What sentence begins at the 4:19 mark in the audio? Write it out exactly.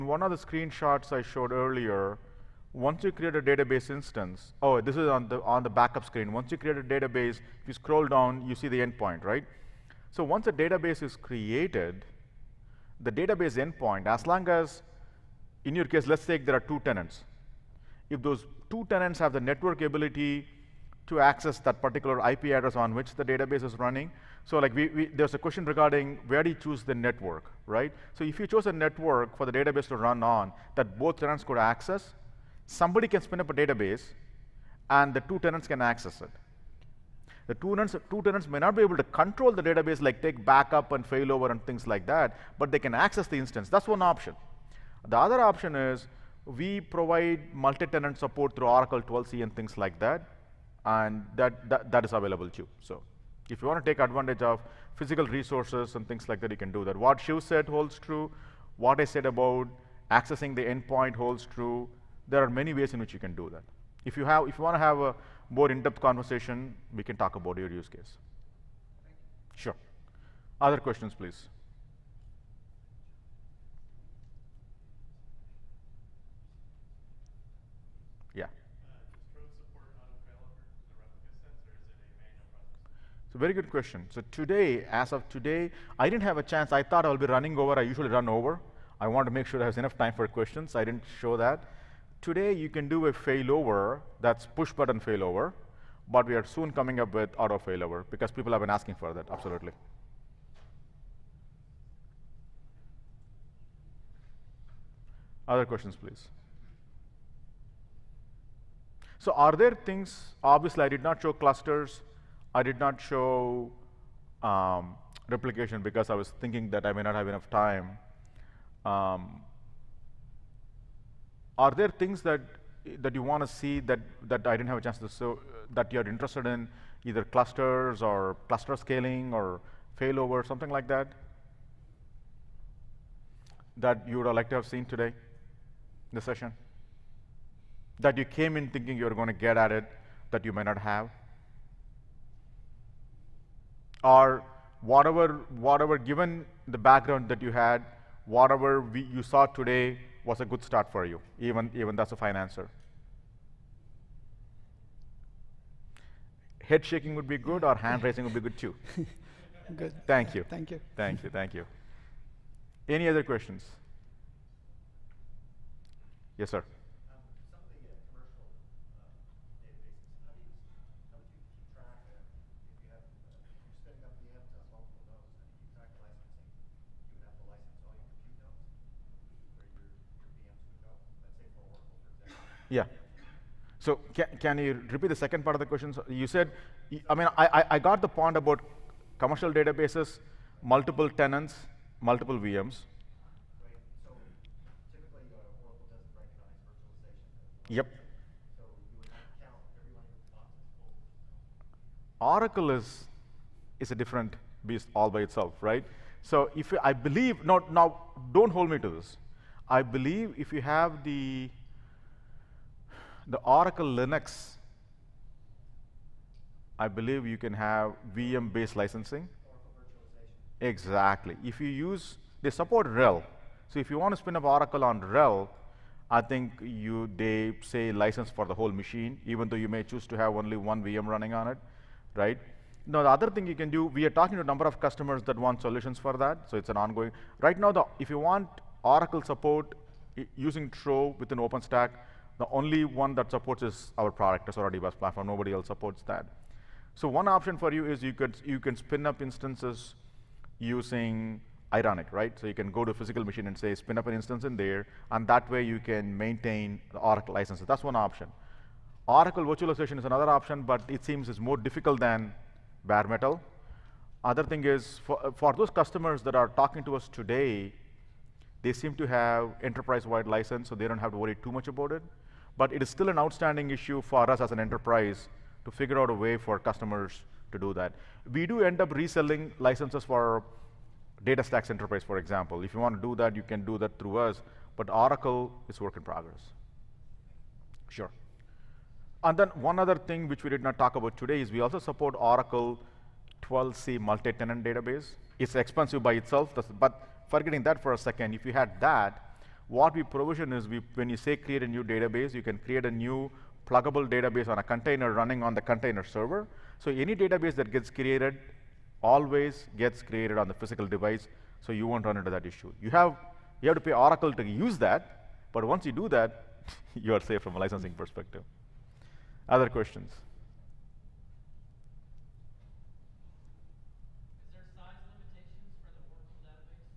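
Oracle virtualization is another option, but it seems is more difficult than bare metal.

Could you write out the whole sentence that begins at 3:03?
So can, can you repeat the second part of the question?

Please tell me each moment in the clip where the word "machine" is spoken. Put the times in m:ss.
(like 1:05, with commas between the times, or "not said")
3:48, 4:13.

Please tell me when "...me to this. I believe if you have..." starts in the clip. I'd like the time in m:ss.
3:28.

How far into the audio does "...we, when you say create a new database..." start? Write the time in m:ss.
5:00.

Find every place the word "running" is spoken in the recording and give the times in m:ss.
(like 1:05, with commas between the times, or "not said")
0:23, 1:27, 3:51, 5:05.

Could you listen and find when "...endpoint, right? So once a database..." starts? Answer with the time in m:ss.
0:08.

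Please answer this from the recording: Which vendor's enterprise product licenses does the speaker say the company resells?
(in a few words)
DataStax.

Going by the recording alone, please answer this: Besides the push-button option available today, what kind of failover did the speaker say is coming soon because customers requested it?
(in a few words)
Auto failover.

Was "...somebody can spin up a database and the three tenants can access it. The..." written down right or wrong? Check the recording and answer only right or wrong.
wrong.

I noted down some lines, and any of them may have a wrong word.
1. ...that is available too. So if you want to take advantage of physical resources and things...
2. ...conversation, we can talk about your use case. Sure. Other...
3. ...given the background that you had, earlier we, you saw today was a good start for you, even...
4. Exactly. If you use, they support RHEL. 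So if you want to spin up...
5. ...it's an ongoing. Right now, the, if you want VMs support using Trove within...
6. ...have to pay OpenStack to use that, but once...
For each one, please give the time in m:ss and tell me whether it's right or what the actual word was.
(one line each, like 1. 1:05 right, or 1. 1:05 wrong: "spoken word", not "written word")
1. 0:51 right
2. 1:05 right
3. 2:25 wrong: "whatever", not "earlier"
4. 3:40 right
5. 3:56 wrong: "Oracle", not "VMs"
6. 5:13 wrong: "Oracle", not "OpenStack".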